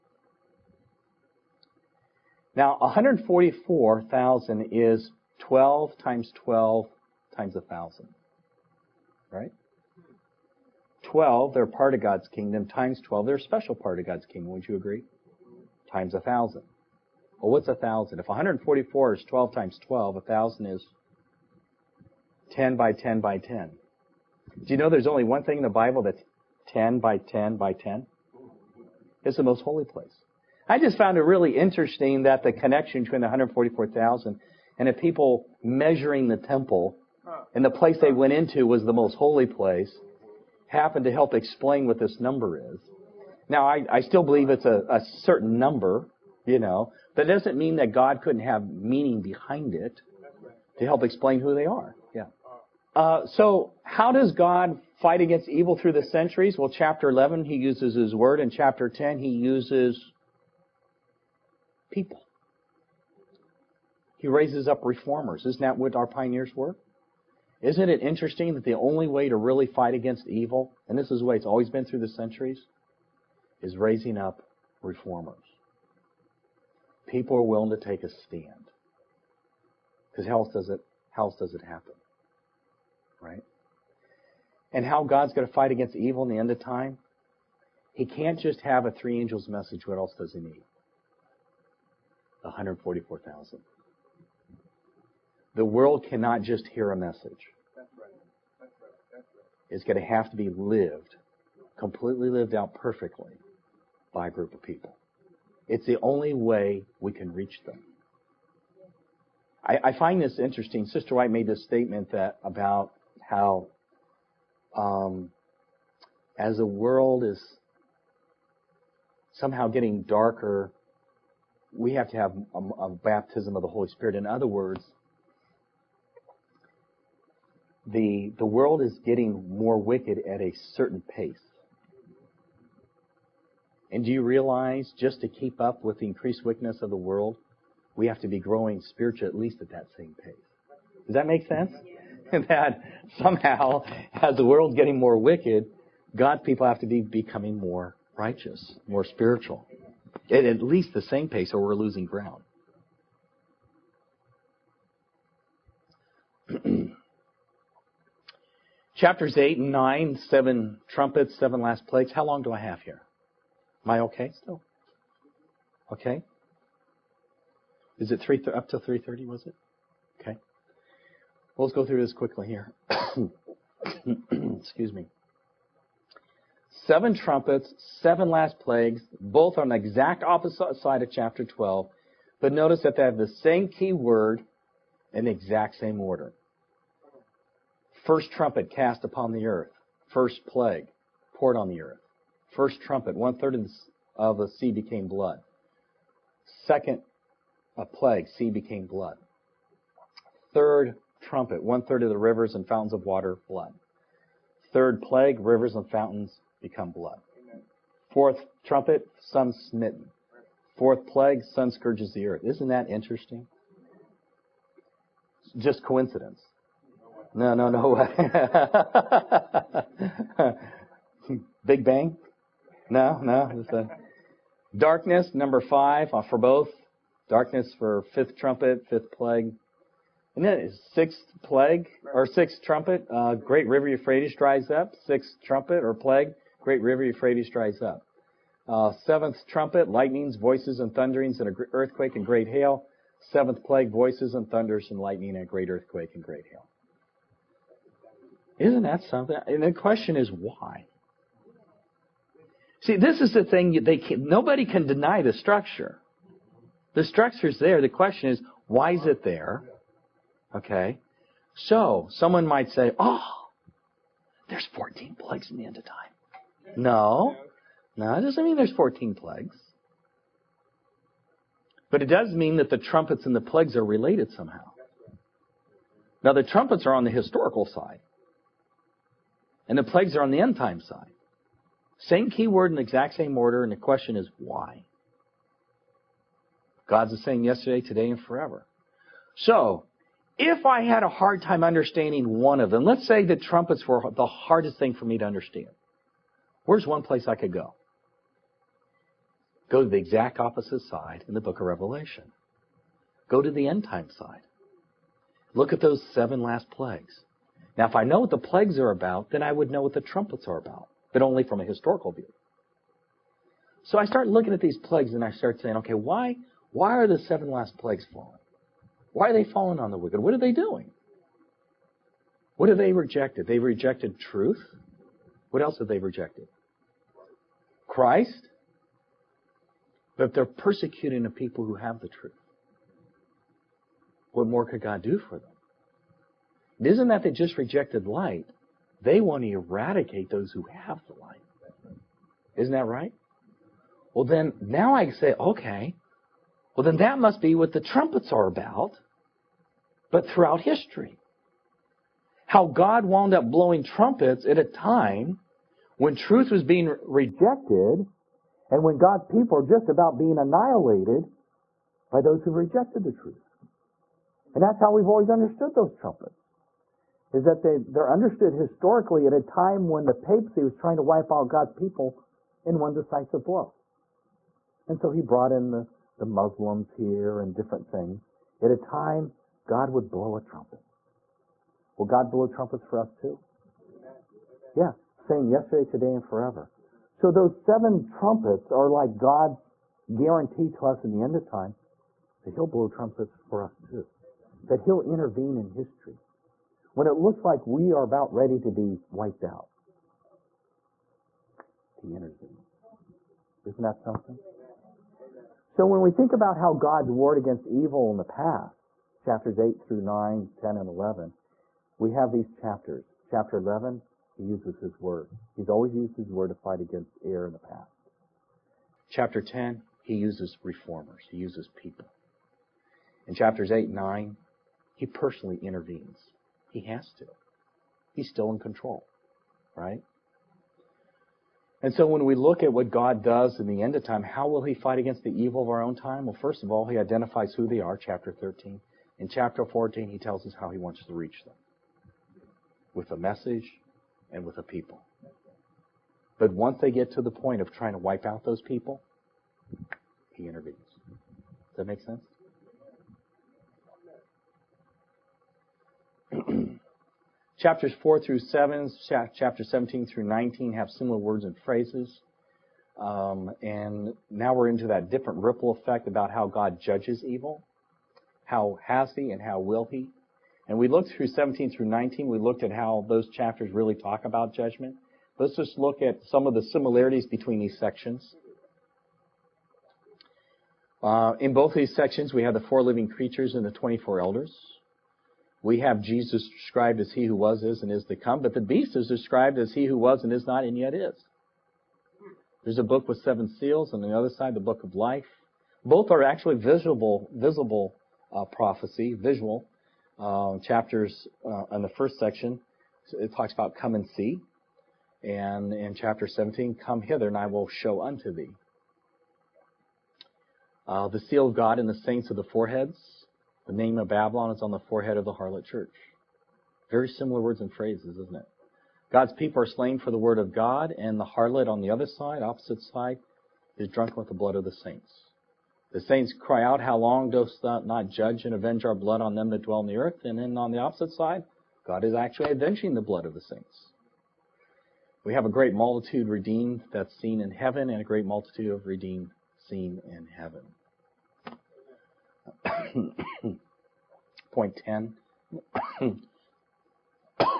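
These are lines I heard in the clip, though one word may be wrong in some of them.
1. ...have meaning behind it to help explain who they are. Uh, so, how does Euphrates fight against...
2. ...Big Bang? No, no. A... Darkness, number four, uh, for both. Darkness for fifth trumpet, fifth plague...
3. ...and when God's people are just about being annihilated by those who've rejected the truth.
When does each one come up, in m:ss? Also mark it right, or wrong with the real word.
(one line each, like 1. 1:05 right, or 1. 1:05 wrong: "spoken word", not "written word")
1. 0:48 wrong: "God", not "Euphrates"
2. 3:41 wrong: "five", not "four"
3. 5:58 right.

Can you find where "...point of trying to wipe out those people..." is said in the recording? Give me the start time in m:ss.
7:27.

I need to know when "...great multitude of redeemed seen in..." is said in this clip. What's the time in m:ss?
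8:58.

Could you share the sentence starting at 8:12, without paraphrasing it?
There's a book with seven seals, and on the other side, the book of life.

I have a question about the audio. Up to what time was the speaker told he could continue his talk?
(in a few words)
3:30.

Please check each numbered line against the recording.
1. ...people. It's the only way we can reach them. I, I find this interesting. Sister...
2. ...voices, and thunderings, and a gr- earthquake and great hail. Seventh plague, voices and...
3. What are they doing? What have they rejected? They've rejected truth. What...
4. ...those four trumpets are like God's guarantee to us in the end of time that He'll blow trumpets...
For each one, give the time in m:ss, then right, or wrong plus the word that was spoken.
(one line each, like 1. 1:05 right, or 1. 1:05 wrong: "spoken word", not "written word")
1. 1:44 right
2. 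4:00 right
3. 5:20 right
4. 6:27 wrong: "seven", not "four".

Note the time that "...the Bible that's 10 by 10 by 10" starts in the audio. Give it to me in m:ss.
0:25.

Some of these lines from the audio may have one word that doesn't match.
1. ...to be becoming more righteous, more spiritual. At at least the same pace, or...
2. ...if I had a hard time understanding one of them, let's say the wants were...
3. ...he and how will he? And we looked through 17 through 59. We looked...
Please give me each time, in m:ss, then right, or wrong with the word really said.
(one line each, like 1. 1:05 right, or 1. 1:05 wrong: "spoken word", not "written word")
1. 2:26 right
2. 4:50 wrong: "trumpets", not "wants"
3. 7:49 wrong: "19", not "59".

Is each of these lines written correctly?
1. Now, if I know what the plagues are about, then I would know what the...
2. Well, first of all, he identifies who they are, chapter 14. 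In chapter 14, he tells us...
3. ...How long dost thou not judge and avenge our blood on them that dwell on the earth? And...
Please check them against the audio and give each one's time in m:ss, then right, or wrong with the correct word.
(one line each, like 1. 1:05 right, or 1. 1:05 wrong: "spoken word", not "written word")
1. 5:07 right
2. 7:16 wrong: "13", not "14"
3. 8:46 right.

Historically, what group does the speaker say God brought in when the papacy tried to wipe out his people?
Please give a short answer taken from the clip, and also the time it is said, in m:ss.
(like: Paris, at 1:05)
The Muslims, at 6:16.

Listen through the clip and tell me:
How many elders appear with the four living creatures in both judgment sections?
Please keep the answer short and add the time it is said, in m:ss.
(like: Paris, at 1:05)
24 elders, at 8:03.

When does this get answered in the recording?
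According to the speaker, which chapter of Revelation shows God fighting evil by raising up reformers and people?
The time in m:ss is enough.
0:58.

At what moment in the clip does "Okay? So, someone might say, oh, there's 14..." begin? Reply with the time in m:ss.
4:20.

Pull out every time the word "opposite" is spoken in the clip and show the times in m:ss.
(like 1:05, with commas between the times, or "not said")
3:00, 5:00, 8:42, 8:50.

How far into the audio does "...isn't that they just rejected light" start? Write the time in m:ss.
5:36.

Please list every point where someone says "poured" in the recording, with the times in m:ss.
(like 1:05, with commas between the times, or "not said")
3:11.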